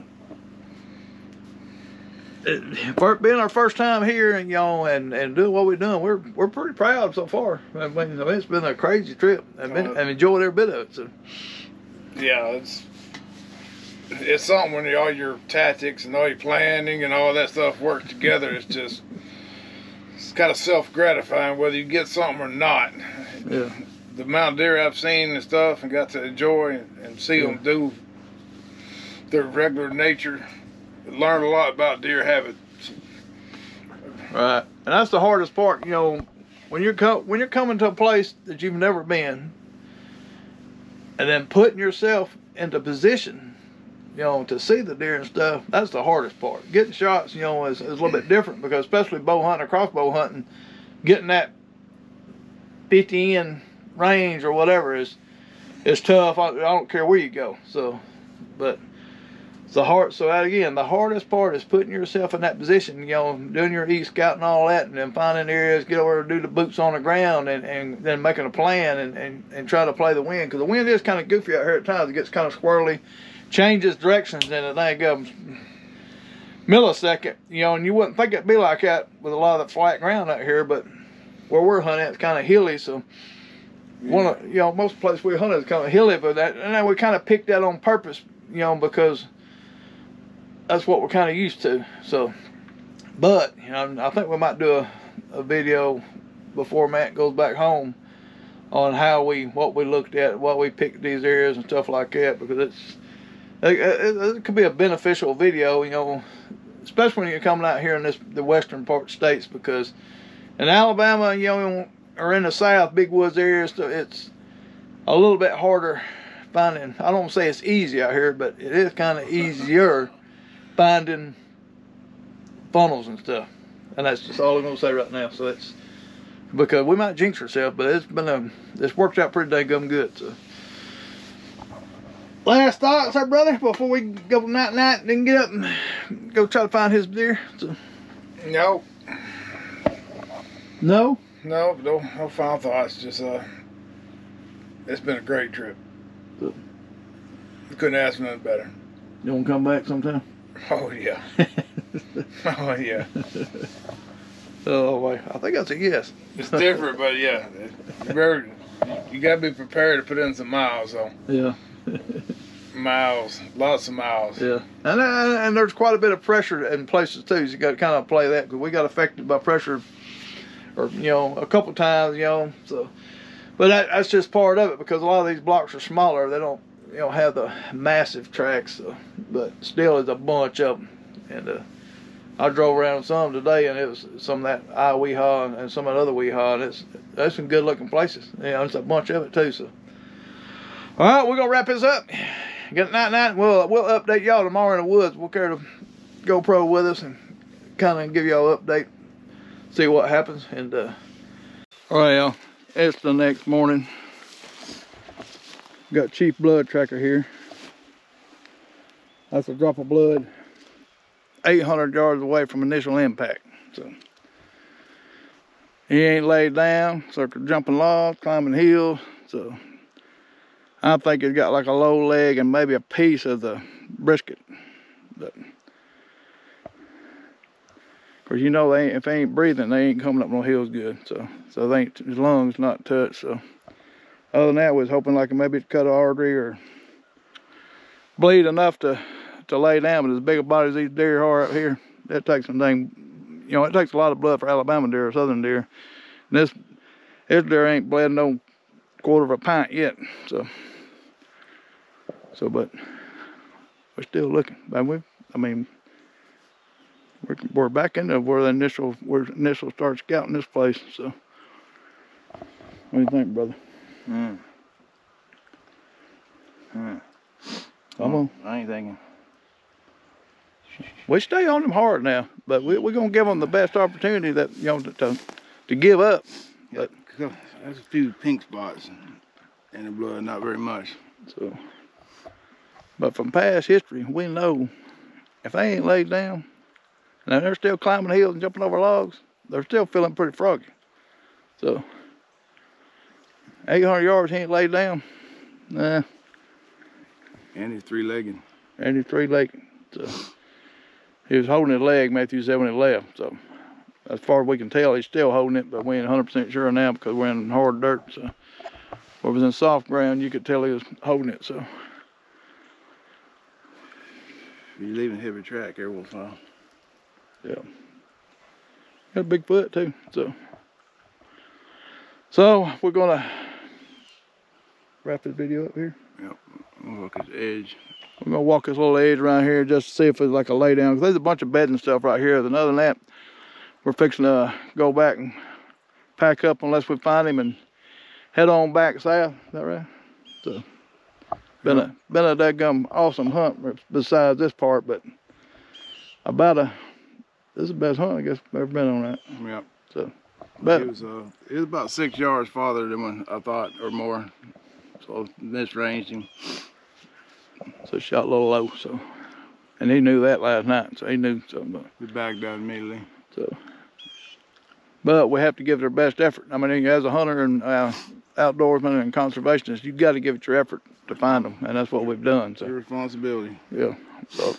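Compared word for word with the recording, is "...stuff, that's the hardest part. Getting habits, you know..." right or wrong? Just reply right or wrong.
wrong.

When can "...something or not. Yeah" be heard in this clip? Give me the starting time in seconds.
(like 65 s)
22 s.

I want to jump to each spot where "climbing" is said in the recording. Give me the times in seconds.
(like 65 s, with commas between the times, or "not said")
218 s, 287 s.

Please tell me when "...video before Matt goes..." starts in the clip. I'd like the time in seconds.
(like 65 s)
95 s.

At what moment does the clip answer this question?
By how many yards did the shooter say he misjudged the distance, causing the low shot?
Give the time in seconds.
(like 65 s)
351 s.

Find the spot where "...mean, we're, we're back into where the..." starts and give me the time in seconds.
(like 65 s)
255 s.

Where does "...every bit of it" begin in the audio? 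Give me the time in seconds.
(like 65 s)
10 s.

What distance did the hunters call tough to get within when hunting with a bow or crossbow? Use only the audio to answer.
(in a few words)
50.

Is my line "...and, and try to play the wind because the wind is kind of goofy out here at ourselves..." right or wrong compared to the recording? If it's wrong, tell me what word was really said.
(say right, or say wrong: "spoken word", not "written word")
wrong: "times", not "ourselves".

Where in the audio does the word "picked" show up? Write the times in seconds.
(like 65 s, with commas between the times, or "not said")
87 s, 100 s.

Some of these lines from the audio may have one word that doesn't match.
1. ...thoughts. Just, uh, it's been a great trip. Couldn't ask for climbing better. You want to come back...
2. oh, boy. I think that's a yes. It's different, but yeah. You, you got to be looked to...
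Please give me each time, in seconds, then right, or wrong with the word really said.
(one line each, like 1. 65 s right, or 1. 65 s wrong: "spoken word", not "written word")
1. 142 s wrong: "nothing", not "climbing"
2. 154 s wrong: "prepared", not "looked".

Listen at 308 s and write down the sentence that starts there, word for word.
So, if it was in soft ground, you could tell he was holding it.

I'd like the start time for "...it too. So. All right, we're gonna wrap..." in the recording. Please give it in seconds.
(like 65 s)
189 s.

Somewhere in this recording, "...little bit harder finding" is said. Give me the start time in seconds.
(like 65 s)
115 s.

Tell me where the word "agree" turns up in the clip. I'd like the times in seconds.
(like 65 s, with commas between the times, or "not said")
not said.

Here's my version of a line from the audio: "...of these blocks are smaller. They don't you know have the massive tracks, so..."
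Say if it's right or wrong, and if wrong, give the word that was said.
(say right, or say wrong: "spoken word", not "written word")
right.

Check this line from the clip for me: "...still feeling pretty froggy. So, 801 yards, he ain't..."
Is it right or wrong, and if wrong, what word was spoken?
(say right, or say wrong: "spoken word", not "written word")
wrong: "800", not "801".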